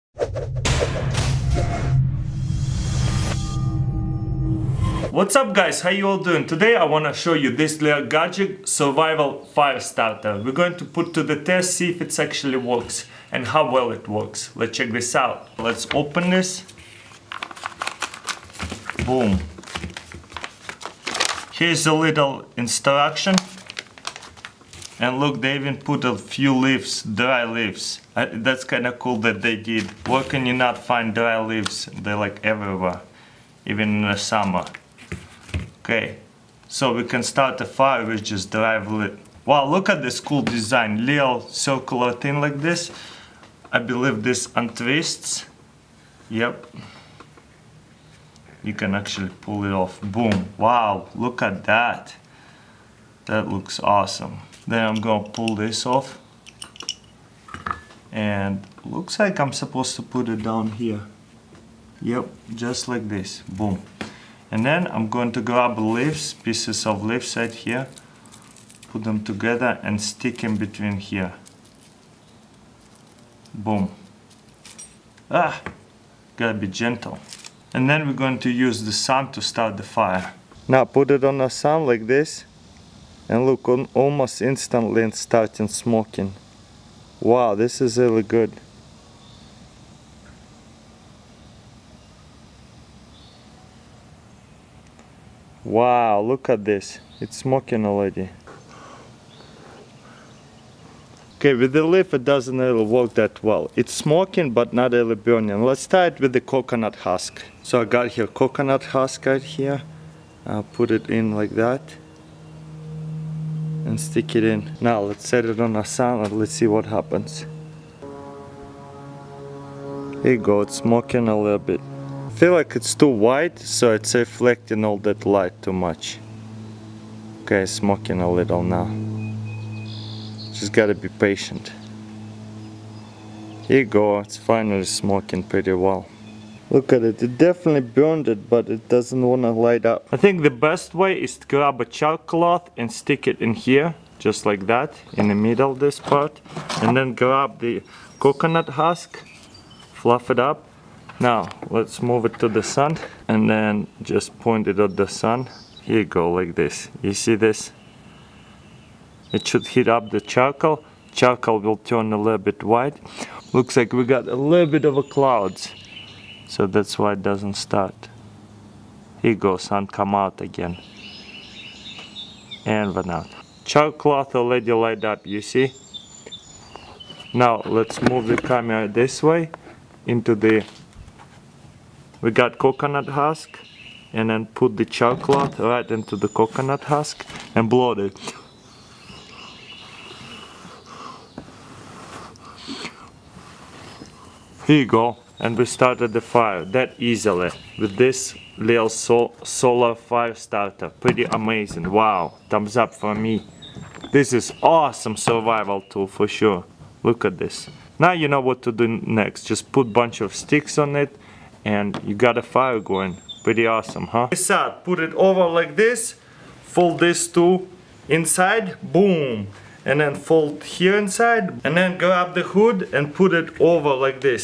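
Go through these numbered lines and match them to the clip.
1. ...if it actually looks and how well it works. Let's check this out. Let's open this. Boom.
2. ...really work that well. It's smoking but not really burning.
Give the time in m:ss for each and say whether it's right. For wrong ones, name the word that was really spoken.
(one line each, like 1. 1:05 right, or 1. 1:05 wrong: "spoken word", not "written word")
1. 0:11 wrong: "works", not "looks"
2. 1:42 right.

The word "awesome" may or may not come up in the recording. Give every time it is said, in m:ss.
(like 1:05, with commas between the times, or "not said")
0:53, 3:24, 3:33.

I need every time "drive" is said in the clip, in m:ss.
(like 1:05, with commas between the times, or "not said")
0:38.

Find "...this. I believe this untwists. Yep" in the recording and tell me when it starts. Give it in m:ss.
0:42.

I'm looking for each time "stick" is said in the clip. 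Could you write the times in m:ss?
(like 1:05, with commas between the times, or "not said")
1:10, 1:53, 2:22, 3:30.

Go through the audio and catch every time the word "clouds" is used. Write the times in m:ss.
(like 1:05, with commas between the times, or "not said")
2:45.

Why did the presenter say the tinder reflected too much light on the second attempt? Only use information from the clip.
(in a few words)
It's too white.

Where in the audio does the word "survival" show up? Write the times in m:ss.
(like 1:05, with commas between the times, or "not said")
0:08, 3:25.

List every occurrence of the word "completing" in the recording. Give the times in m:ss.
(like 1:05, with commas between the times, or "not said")
not said.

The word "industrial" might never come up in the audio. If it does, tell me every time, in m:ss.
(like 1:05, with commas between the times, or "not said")
not said.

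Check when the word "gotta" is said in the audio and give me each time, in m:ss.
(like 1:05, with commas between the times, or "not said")
1:16, 2:10.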